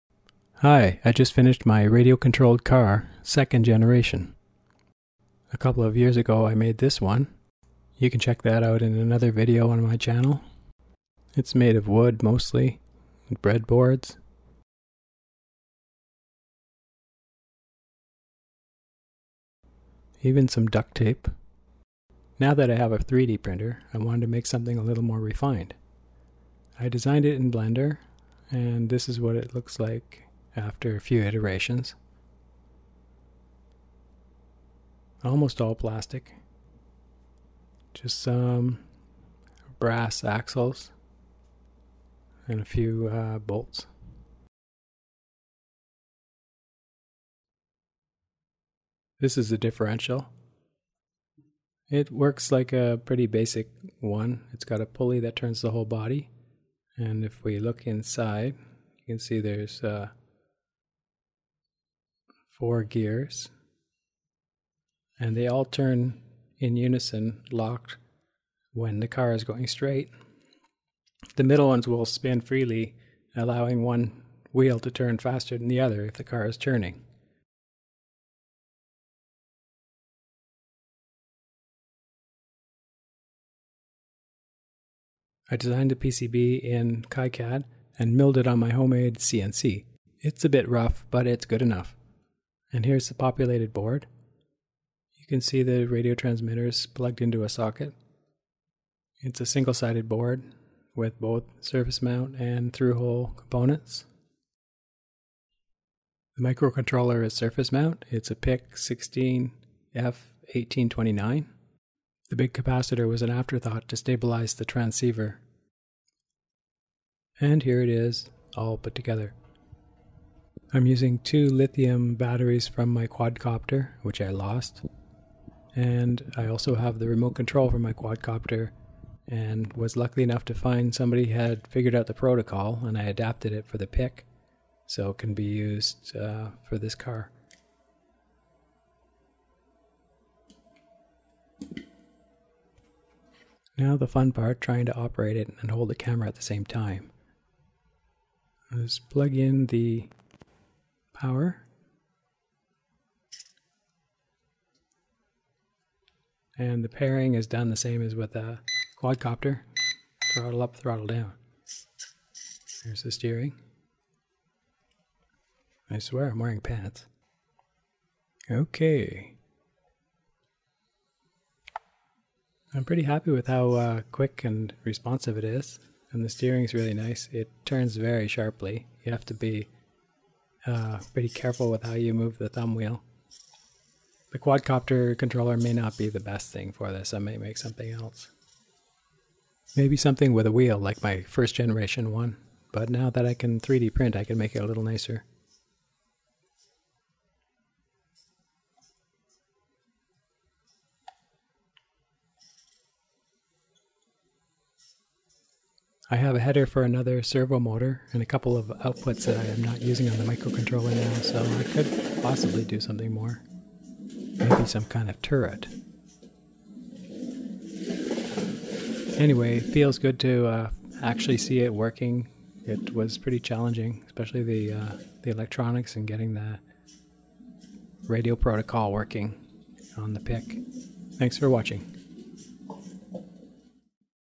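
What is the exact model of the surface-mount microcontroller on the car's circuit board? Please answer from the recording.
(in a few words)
PIC 16F1829.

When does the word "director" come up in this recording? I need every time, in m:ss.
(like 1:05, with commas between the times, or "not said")
not said.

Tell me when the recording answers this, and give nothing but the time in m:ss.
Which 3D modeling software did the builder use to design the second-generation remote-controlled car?
0:27.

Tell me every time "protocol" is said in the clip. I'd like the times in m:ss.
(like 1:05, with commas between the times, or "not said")
2:12, 3:48.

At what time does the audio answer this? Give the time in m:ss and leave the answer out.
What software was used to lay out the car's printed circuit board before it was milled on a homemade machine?
1:27.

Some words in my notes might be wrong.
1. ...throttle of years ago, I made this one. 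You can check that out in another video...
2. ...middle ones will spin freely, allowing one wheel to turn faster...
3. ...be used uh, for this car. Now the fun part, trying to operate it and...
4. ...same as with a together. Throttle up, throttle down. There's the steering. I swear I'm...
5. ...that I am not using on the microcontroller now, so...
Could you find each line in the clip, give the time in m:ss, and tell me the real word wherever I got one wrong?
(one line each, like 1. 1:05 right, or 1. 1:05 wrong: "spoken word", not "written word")
1. 0:05 wrong: "couple", not "throttle"
2. 1:11 right
3. 2:15 right
4. 2:37 wrong: "quadcopter", not "together"
5. 3:29 right.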